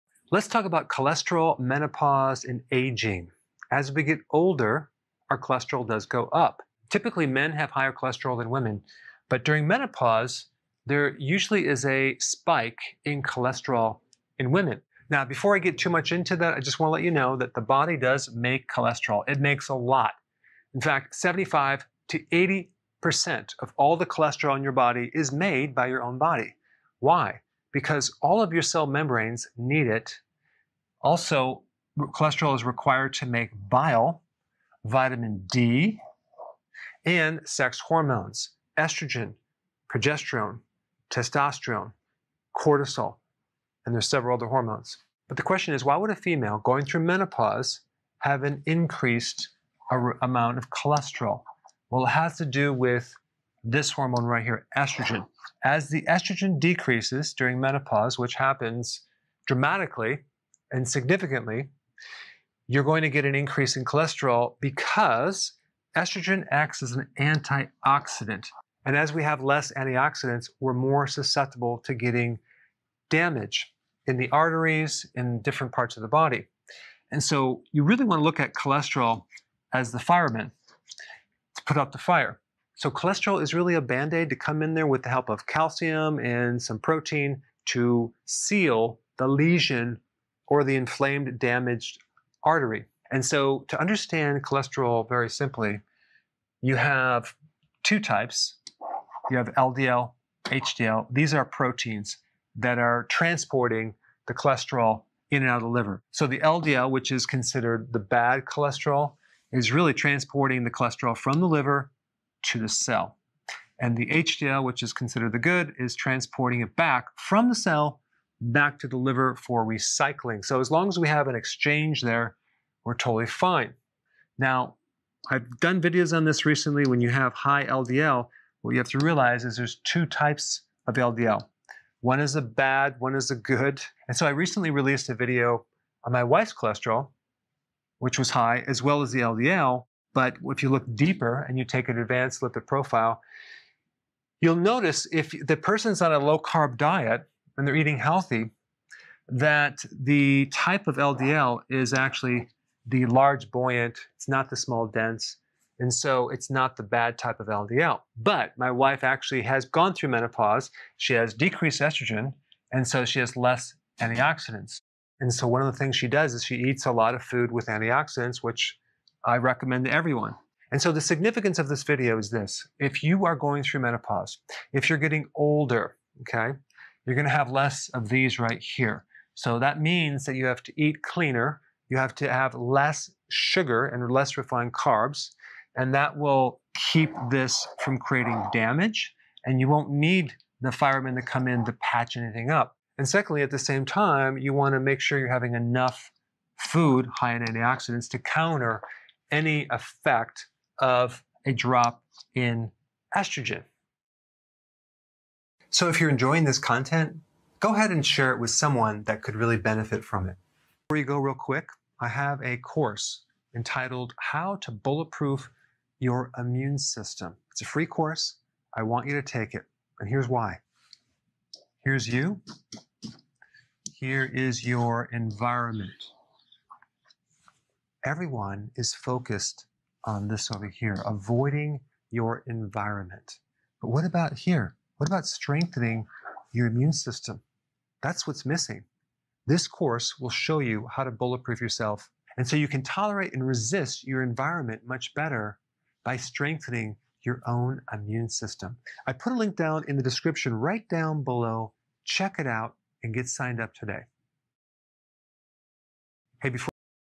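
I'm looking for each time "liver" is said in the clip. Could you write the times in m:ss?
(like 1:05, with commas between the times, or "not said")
1:45, 1:51, 1:58.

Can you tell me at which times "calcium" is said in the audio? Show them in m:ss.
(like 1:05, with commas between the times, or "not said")
1:25.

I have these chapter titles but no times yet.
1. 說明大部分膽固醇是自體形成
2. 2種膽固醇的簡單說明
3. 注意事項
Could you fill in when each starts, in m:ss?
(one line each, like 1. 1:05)
1. 0:16
2. 1:36
3. 2:50.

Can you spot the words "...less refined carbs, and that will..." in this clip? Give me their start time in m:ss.
3:04.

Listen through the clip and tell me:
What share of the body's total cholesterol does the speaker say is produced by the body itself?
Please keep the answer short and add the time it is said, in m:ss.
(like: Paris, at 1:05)
75 to 80%, at 0:21.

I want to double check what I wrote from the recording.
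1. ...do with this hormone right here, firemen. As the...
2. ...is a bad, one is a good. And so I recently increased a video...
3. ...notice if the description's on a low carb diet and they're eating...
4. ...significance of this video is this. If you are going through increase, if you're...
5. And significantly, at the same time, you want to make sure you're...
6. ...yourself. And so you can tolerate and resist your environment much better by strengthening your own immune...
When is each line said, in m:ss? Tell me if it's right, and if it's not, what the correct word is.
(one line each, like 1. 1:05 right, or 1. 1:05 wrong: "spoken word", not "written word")
1. 0:52 wrong: "estrogen", not "firemen"
2. 2:12 wrong: "released", not "increased"
3. 2:24 wrong: "person", not "description"
4. 2:51 wrong: "menopause", not "increase"
5. 3:12 wrong: "secondly", not "significantly"
6. 4:01 right.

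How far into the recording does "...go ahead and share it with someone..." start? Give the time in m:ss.
3:27.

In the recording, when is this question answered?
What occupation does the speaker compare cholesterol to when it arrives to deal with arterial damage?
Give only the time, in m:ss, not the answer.
1:19.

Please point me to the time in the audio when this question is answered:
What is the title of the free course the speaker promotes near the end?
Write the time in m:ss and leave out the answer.
3:34.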